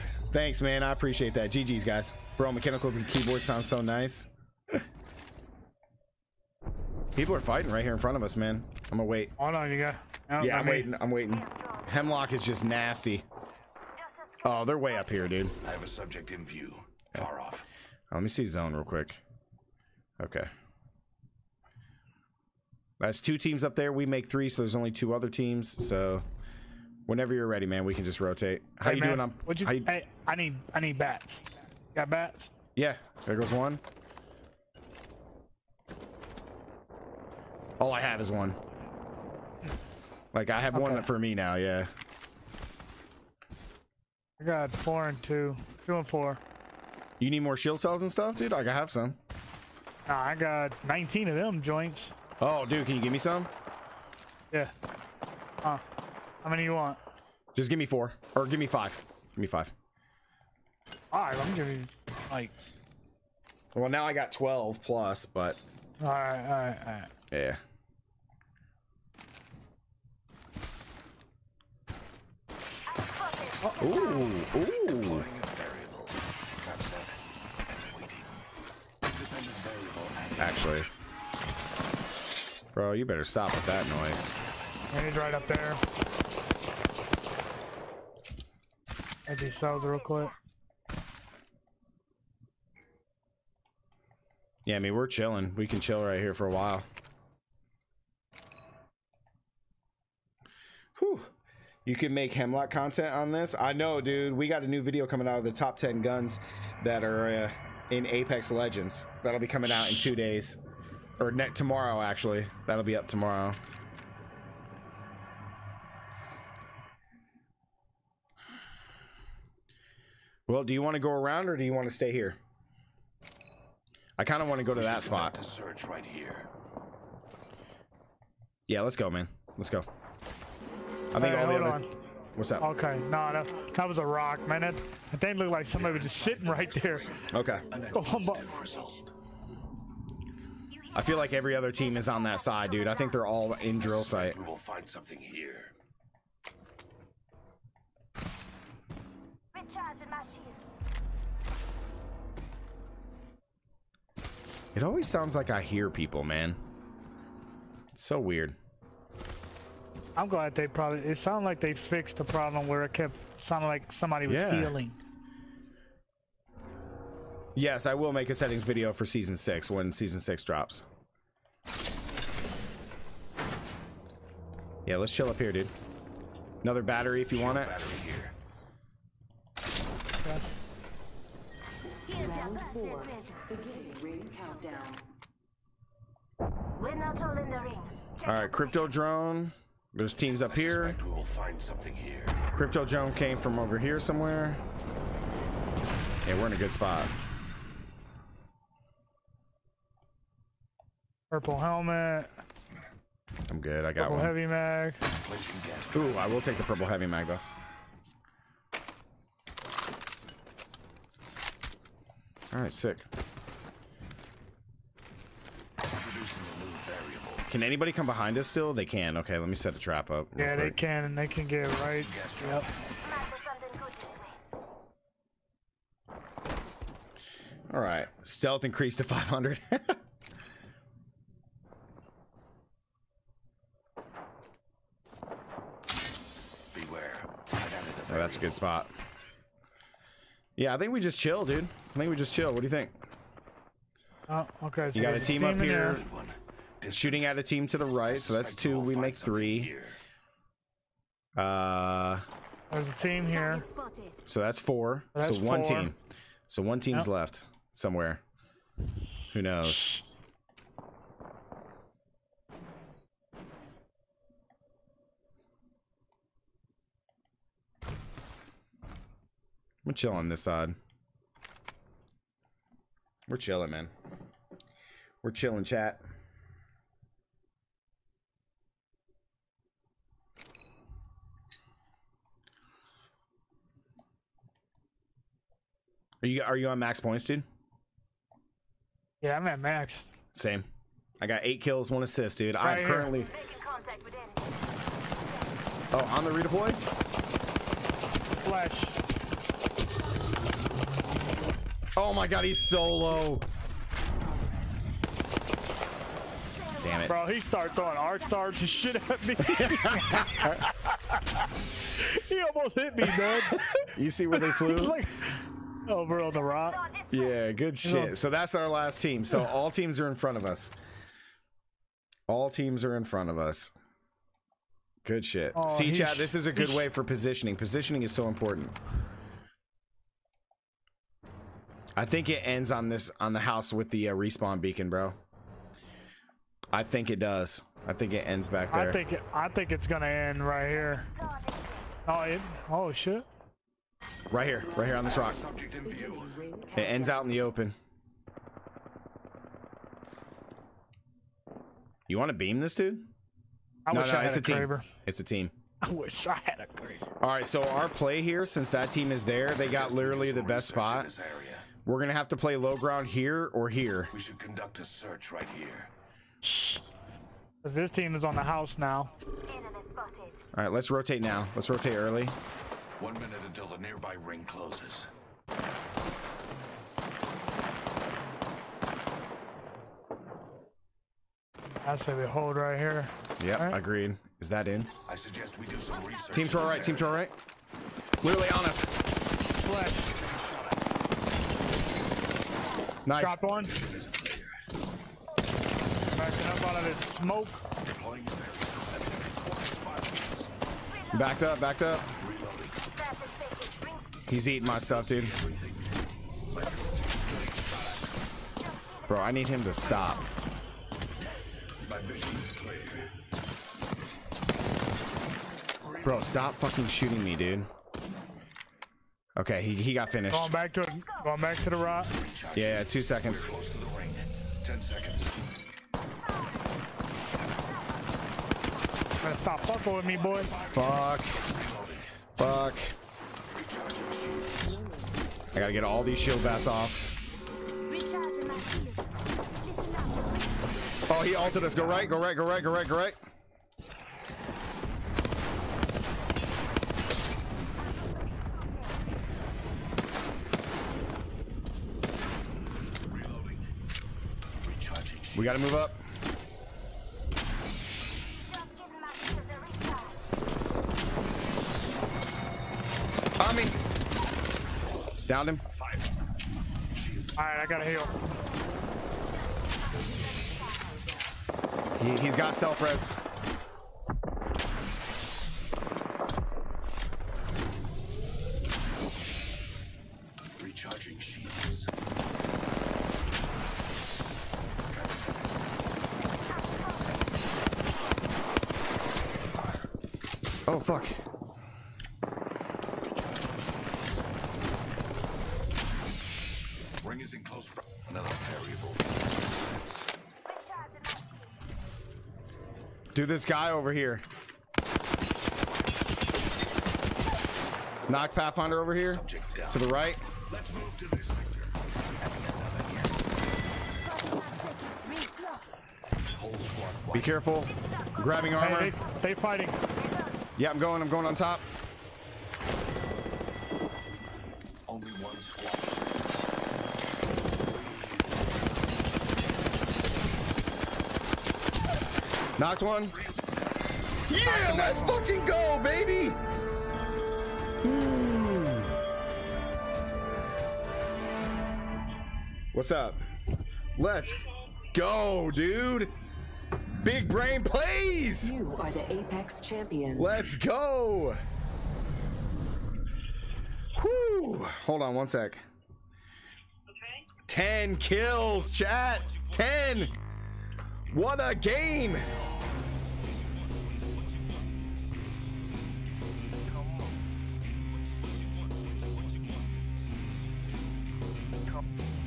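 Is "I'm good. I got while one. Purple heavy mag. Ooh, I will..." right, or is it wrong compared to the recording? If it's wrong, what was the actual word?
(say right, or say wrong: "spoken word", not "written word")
wrong: "purple", not "while".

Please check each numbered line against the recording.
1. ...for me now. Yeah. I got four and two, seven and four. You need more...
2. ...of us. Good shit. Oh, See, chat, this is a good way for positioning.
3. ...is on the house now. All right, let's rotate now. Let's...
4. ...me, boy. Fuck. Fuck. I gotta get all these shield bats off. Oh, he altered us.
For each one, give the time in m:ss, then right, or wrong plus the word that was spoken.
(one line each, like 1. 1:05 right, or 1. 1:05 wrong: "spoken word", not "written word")
1. 0:41 wrong: "two", not "seven"
2. 5:23 right
3. 6:08 right
4. 7:10 right.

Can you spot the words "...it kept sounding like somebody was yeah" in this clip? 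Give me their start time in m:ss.
2:42.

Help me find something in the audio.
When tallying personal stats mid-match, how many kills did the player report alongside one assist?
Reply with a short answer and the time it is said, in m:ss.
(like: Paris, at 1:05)
Eight, at 4:51.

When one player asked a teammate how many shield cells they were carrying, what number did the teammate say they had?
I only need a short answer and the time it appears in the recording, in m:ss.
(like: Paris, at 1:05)
19, at 0:50.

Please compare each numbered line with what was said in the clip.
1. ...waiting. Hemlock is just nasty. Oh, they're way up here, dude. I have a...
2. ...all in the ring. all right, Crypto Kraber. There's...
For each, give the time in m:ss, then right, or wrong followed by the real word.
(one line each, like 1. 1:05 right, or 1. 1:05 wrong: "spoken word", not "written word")
1. 0:11 right
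2. 3:07 wrong: "Drone", not "Kraber".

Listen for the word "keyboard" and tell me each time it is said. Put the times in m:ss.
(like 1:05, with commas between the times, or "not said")
0:02.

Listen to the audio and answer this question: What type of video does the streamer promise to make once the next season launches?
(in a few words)
Settings video.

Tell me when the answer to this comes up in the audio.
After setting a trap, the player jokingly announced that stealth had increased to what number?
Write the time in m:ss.
3:49.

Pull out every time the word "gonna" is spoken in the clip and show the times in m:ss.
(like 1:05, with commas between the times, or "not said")
0:08, 5:39, 6:01.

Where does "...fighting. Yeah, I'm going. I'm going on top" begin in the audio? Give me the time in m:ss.
8:39.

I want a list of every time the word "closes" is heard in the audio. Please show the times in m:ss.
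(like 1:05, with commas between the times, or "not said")
6:14, 8:17.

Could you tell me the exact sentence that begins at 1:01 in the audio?
Alright, I'm giving like Well now I got twelve plus, but Alright, alright, alright.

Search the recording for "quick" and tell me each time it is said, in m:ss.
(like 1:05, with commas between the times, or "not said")
0:18, 1:29, 3:40.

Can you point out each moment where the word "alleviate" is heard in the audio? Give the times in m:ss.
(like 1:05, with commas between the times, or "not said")
not said.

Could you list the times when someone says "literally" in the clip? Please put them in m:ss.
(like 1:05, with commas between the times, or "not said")
5:59, 6:28.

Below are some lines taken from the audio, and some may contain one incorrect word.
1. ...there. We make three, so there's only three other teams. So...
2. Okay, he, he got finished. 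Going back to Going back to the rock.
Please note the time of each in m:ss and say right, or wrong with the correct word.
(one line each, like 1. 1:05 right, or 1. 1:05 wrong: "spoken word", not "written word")
1. 0:23 wrong: "two", not "three"
2. 6:59 right.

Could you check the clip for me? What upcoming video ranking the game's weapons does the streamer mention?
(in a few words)
Top 10 guns.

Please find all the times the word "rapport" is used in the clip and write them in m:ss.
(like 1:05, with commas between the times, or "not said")
not said.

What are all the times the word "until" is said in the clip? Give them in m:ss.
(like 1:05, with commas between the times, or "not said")
6:13.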